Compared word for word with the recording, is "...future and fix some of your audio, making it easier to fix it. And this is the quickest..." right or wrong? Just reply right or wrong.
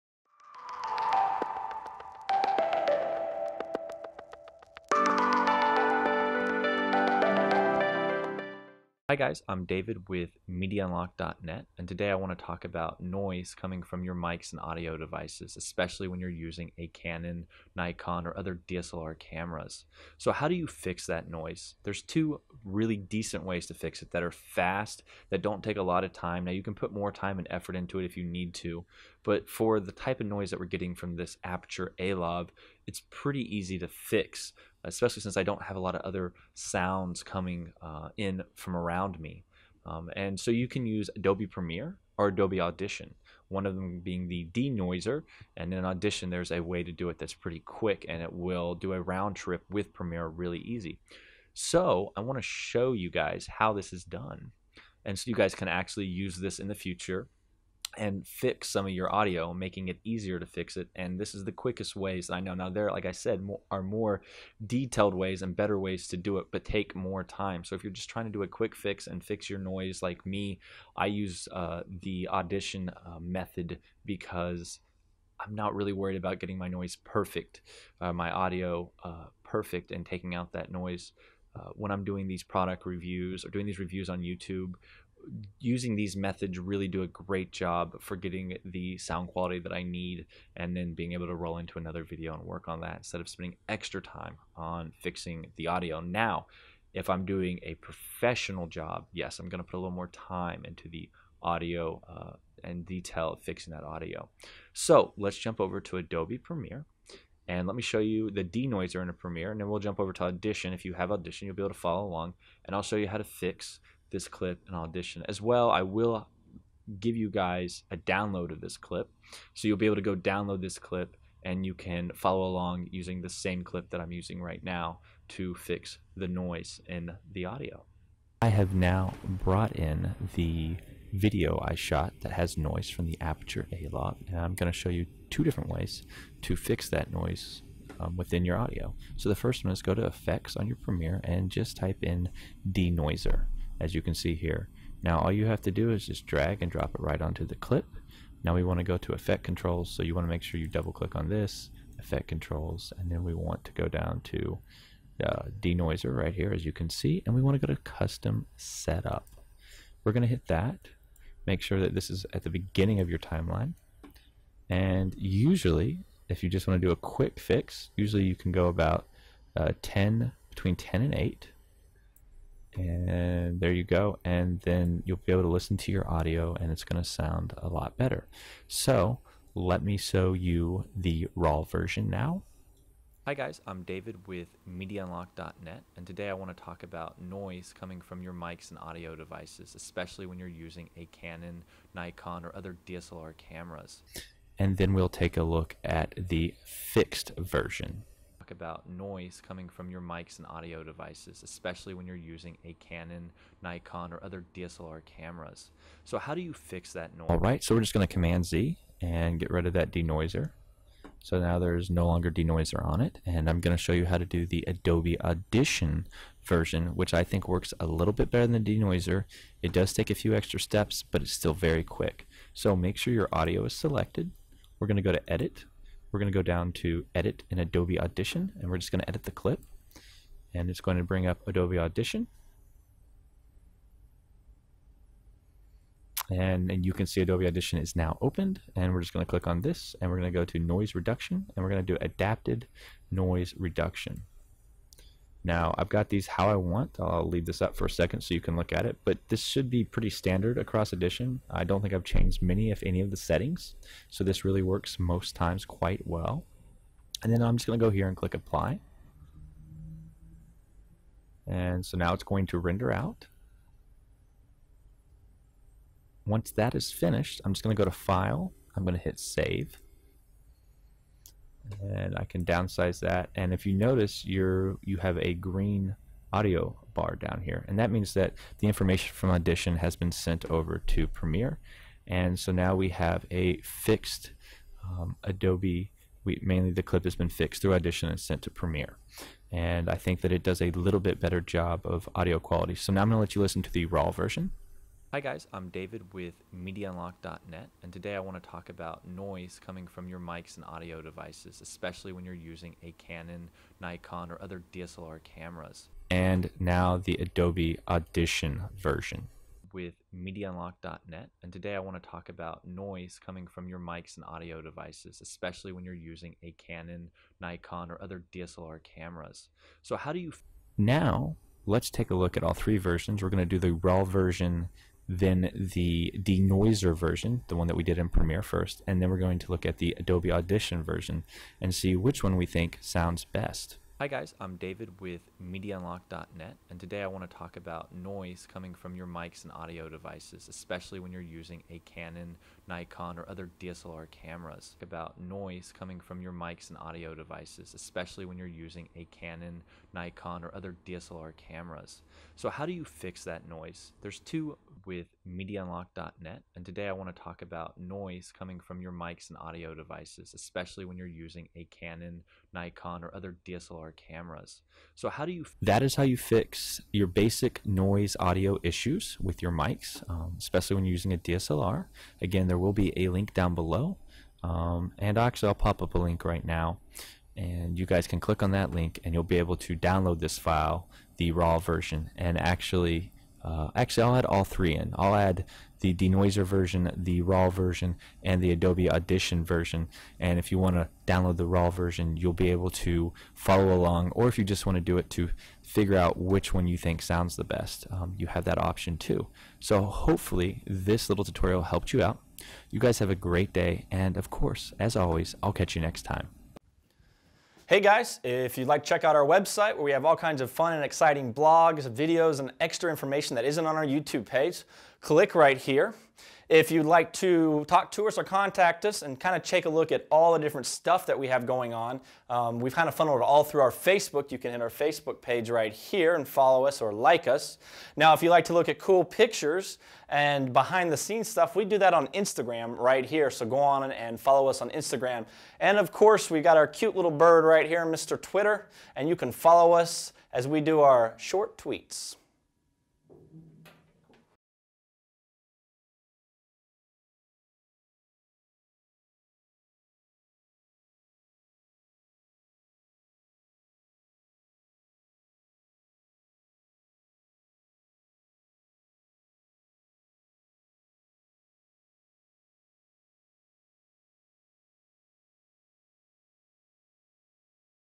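right.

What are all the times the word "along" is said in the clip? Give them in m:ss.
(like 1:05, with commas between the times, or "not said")
1:52, 2:02, 6:33.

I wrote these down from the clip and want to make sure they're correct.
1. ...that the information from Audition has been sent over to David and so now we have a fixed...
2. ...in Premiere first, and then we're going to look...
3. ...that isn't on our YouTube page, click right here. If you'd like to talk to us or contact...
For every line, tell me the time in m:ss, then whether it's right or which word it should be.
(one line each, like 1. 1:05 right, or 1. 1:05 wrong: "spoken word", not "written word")
1. 4:38 wrong: "Premiere", not "David"
2. 5:27 right
3. 6:53 right.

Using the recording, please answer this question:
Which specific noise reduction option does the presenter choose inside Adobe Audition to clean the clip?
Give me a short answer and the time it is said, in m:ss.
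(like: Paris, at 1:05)
adaptive noise reduction, at 4:02.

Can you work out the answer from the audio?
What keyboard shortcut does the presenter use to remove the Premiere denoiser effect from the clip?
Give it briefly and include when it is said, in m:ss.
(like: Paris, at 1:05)
Command Z, at 3:28.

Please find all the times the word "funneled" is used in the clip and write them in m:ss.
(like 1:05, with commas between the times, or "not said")
7:02.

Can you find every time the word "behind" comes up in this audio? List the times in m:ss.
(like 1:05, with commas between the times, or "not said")
7:10.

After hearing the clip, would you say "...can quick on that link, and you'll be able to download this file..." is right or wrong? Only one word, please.
wrong.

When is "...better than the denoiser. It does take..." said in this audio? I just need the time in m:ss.
3:38.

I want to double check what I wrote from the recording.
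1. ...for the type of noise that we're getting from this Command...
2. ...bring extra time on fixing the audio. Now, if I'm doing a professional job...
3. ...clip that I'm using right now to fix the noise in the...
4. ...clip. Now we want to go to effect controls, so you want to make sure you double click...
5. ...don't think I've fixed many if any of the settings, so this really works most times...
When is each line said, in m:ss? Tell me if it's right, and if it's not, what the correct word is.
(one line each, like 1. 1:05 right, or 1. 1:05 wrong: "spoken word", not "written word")
1. 0:29 wrong: "Aperture", not "Command"
2. 1:33 wrong: "spending", not "bring"
3. 2:03 right
4. 2:27 right
5. 4:11 wrong: "changed", not "fixed".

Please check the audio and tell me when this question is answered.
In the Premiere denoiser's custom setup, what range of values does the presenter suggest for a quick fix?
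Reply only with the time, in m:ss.
2:50.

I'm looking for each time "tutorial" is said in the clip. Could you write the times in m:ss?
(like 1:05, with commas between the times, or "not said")
6:41.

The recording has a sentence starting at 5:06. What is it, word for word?
And now the Adobe Audition version.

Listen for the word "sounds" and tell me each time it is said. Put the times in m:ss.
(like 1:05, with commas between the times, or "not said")
0:36, 1:28, 2:57, 5:32, 6:37.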